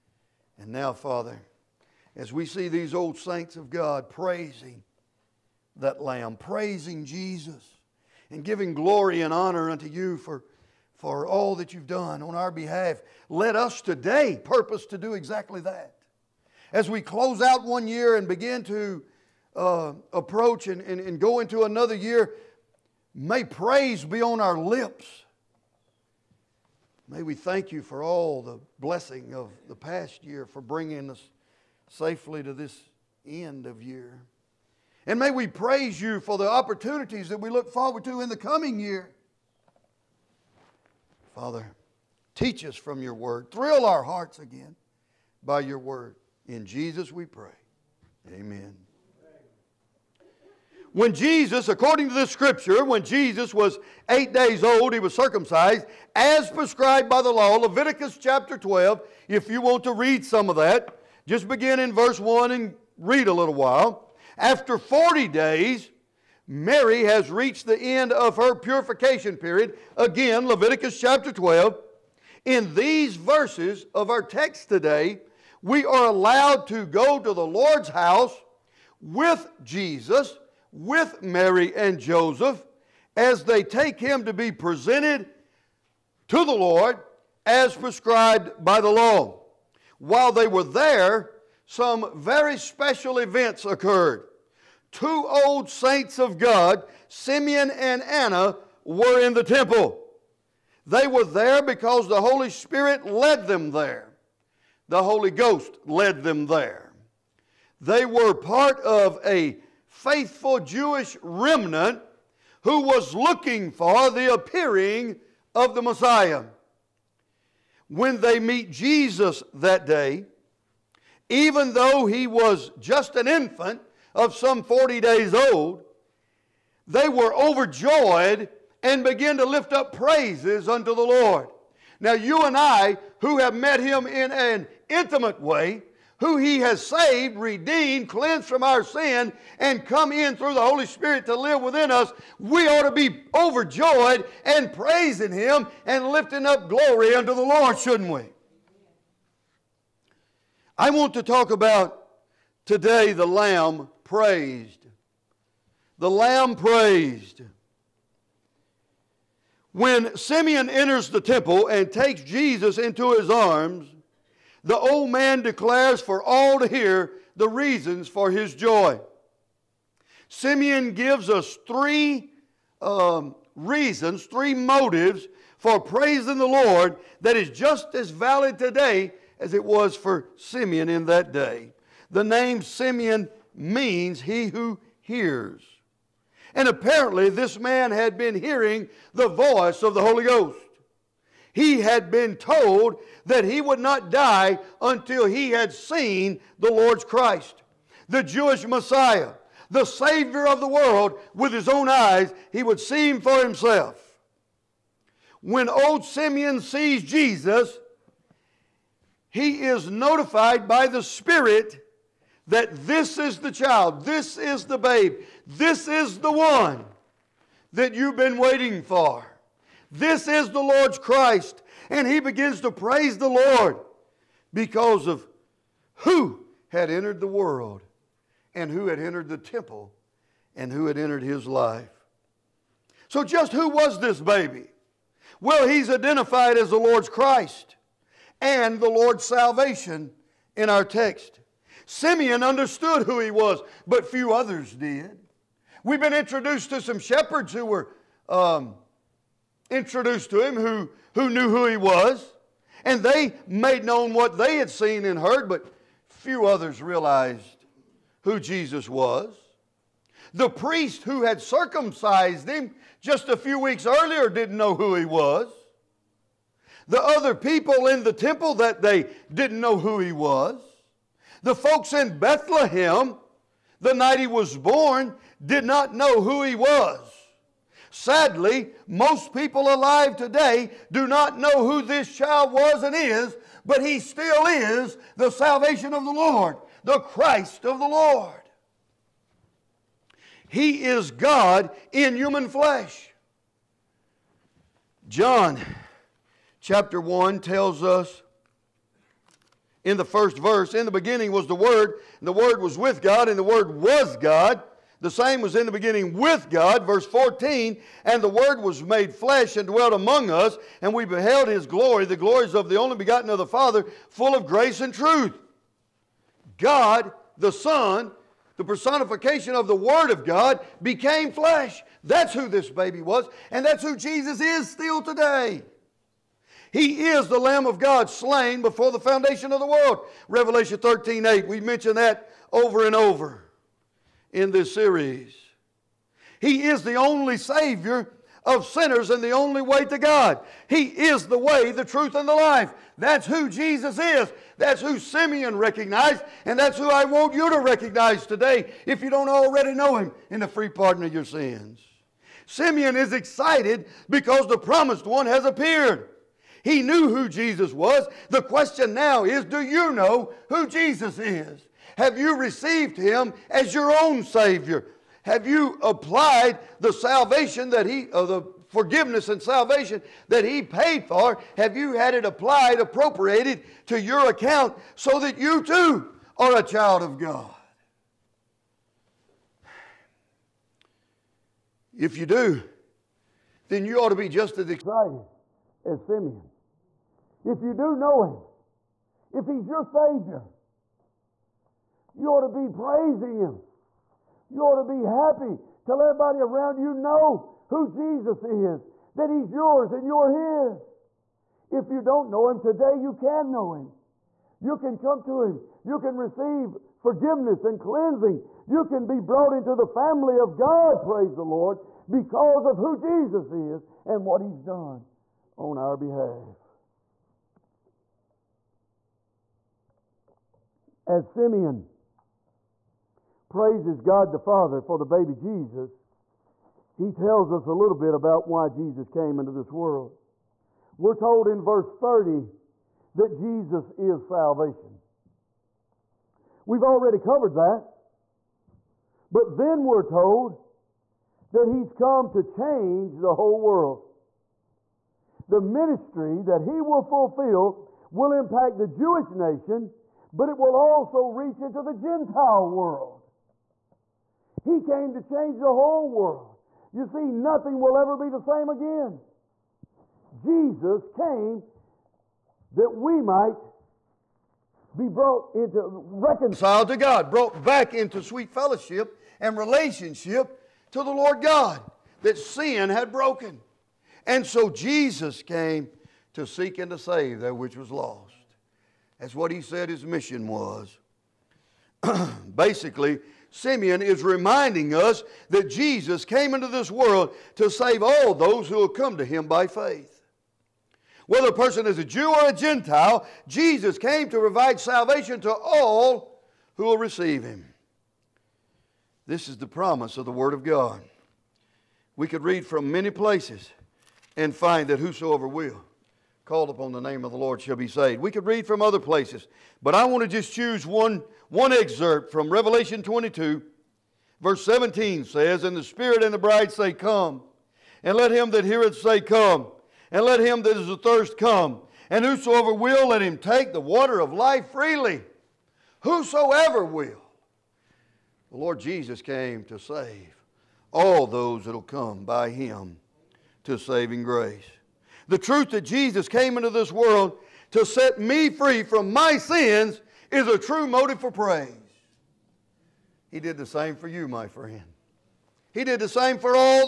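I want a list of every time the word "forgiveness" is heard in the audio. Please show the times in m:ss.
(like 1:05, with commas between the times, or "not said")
6:08, 6:46.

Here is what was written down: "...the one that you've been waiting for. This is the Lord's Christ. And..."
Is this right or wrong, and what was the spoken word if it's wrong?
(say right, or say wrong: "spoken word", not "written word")
right.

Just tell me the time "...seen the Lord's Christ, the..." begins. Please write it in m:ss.
3:15.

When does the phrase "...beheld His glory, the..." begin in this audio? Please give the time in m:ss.
5:11.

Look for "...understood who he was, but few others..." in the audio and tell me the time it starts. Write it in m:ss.
4:02.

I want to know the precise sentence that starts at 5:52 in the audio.
Simeon is excited because the promised one has appeared.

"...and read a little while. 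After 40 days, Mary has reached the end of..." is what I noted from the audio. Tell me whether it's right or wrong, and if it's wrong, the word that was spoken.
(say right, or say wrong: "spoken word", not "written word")
right.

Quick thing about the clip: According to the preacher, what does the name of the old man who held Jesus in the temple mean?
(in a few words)
He who hears.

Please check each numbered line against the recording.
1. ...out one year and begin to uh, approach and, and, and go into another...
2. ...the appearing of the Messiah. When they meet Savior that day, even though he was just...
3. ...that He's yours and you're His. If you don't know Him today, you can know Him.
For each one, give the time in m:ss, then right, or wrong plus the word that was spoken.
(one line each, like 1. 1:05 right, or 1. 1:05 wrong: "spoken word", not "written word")
1. 0:17 right
2. 1:54 wrong: "Jesus", not "Savior"
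3. 6:39 right.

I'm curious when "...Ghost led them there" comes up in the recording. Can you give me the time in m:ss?
1:45.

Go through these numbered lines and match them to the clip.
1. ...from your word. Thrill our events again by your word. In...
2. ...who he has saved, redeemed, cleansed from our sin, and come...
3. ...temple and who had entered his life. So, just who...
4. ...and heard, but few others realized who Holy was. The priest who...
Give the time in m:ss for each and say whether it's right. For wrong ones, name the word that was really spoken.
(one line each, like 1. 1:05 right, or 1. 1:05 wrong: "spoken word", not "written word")
1. 0:42 wrong: "hearts", not "events"
2. 2:16 right
3. 3:49 right
4. 4:15 wrong: "Jesus", not "Holy".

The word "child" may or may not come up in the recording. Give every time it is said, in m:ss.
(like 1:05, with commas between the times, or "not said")
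3:33, 4:42, 6:16.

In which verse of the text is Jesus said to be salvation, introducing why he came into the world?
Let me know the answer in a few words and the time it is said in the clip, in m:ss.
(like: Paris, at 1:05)
Verse 30, at 7:11.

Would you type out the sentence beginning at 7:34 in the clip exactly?
He came to change the whole world.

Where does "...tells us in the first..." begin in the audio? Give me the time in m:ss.
4:57.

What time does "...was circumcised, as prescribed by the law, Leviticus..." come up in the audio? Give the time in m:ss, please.
0:54.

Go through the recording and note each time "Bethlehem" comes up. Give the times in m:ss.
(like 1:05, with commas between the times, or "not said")
4:32.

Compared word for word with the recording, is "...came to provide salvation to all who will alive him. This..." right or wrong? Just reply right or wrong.
wrong.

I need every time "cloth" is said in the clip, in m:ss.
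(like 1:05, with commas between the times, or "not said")
not said.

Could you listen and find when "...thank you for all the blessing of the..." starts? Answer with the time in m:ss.
0:27.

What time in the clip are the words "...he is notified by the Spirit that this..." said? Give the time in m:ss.
3:29.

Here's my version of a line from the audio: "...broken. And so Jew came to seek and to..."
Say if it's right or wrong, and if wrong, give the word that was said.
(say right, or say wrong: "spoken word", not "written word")
wrong: "Jesus", not "Jew".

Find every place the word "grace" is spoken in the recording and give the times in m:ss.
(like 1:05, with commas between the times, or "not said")
5:14, 8:54.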